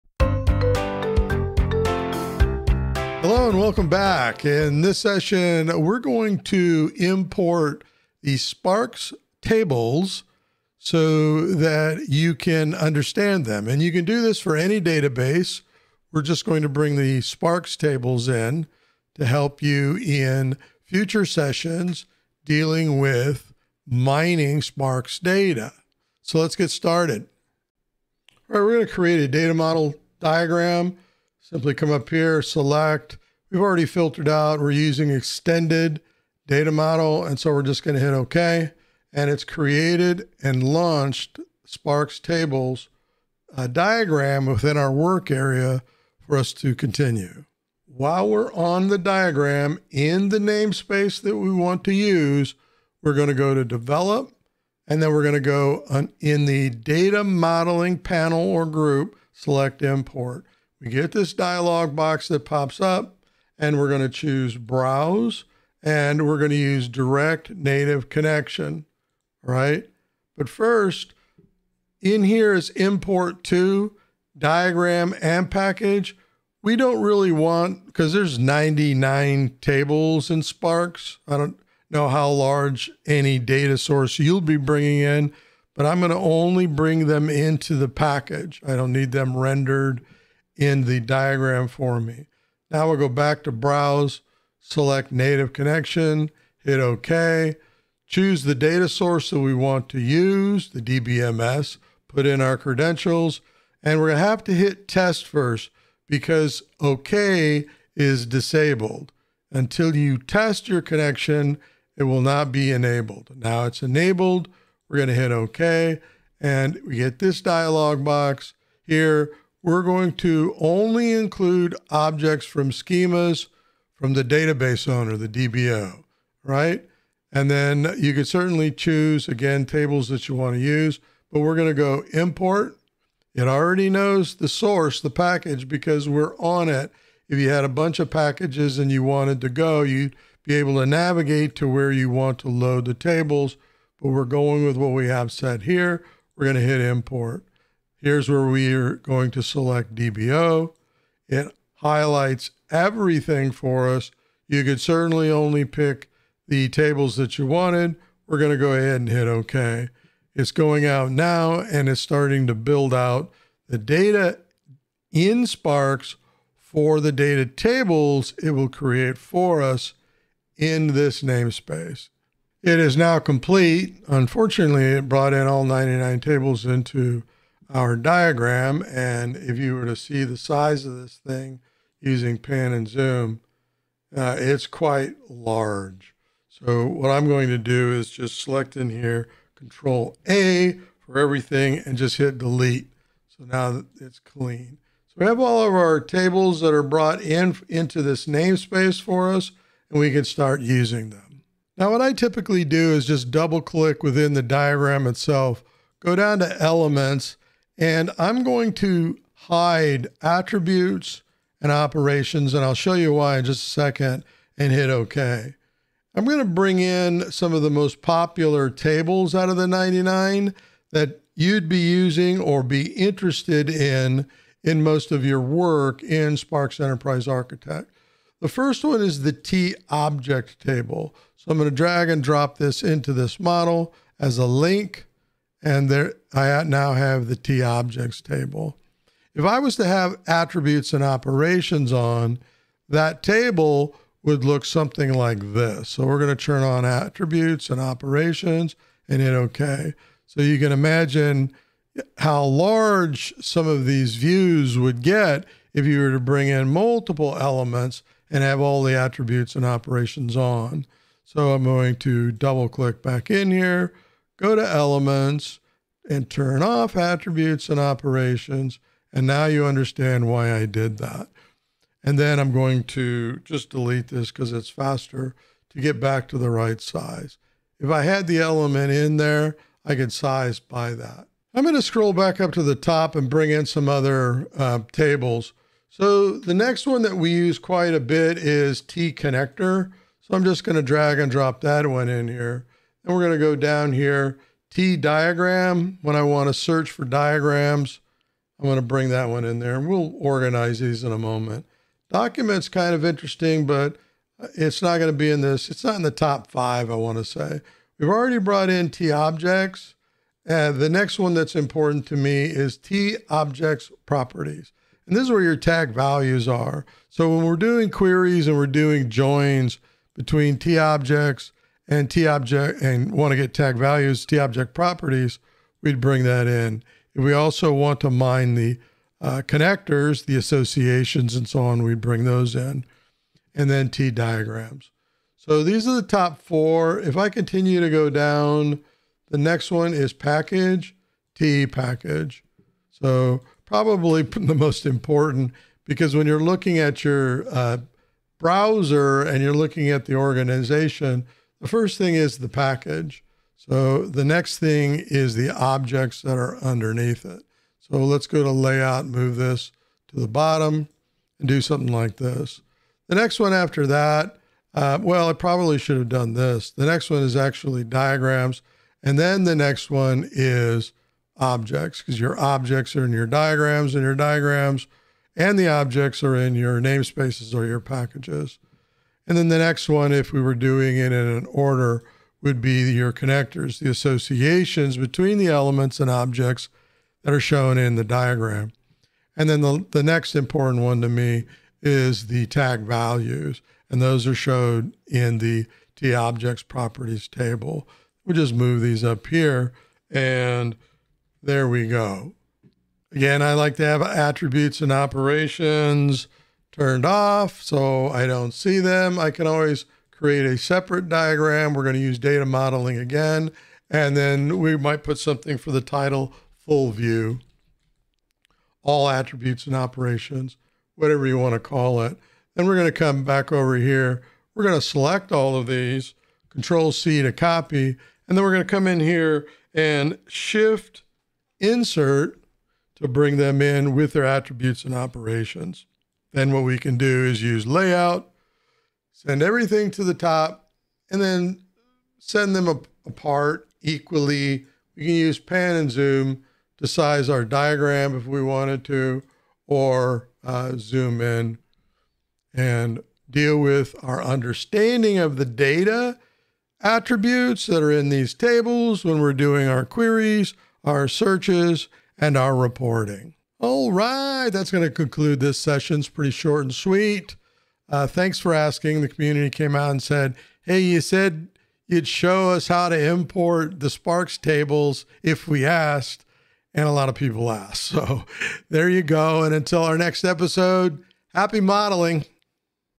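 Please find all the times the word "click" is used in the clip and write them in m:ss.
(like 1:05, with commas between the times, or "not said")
3:23, 4:22.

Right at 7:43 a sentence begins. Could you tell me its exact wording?
All right, that's going to conclude this session.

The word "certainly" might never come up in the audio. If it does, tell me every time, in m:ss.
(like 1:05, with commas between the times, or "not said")
2:08, 2:34.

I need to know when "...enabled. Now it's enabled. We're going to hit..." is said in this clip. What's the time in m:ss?
1:52.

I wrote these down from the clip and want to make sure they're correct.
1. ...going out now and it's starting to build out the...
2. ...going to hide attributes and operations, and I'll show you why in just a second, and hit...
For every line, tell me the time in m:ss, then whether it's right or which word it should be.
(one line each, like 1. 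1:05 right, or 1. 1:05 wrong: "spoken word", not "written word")
1. 2:40 right
2. 3:28 right.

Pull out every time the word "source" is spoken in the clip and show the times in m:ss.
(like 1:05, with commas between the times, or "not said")
1:23, 1:38, 2:14.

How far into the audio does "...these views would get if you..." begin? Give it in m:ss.
4:13.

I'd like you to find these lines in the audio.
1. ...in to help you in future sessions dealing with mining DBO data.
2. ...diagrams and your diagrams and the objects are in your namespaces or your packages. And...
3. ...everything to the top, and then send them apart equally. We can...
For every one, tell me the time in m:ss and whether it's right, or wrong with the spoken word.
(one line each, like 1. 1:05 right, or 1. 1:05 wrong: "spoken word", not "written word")
1. 0:18 wrong: "Sparx", not "DBO"
2. 6:13 right
3. 7:19 right.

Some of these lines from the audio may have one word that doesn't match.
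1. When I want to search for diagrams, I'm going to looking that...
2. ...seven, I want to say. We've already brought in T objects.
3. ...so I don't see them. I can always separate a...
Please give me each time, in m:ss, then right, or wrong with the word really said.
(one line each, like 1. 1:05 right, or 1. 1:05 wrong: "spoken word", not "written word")
1. 4:56 wrong: "bring", not "looking"
2. 5:06 wrong: "five", not "seven"
3. 6:47 wrong: "create", not "separate".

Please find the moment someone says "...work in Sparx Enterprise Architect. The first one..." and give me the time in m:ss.
3:45.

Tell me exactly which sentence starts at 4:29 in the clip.
And now you understand why I did that.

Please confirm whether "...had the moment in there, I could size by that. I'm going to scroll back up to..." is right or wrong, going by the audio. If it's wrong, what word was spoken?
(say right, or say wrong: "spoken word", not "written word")
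wrong: "element", not "moment".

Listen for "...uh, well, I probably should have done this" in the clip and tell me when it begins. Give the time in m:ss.
6:04.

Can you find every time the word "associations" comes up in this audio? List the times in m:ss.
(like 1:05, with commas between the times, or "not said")
5:30, 6:23.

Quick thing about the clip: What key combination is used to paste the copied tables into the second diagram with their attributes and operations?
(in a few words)
Shift Insert.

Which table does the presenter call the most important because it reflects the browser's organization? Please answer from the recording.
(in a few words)
T package.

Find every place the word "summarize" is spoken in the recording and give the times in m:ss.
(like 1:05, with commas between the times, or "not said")
not said.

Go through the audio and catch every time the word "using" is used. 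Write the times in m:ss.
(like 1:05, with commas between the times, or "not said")
0:34, 3:01, 3:20, 3:41.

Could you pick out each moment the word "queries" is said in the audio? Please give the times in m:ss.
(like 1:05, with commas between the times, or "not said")
5:17, 7:39.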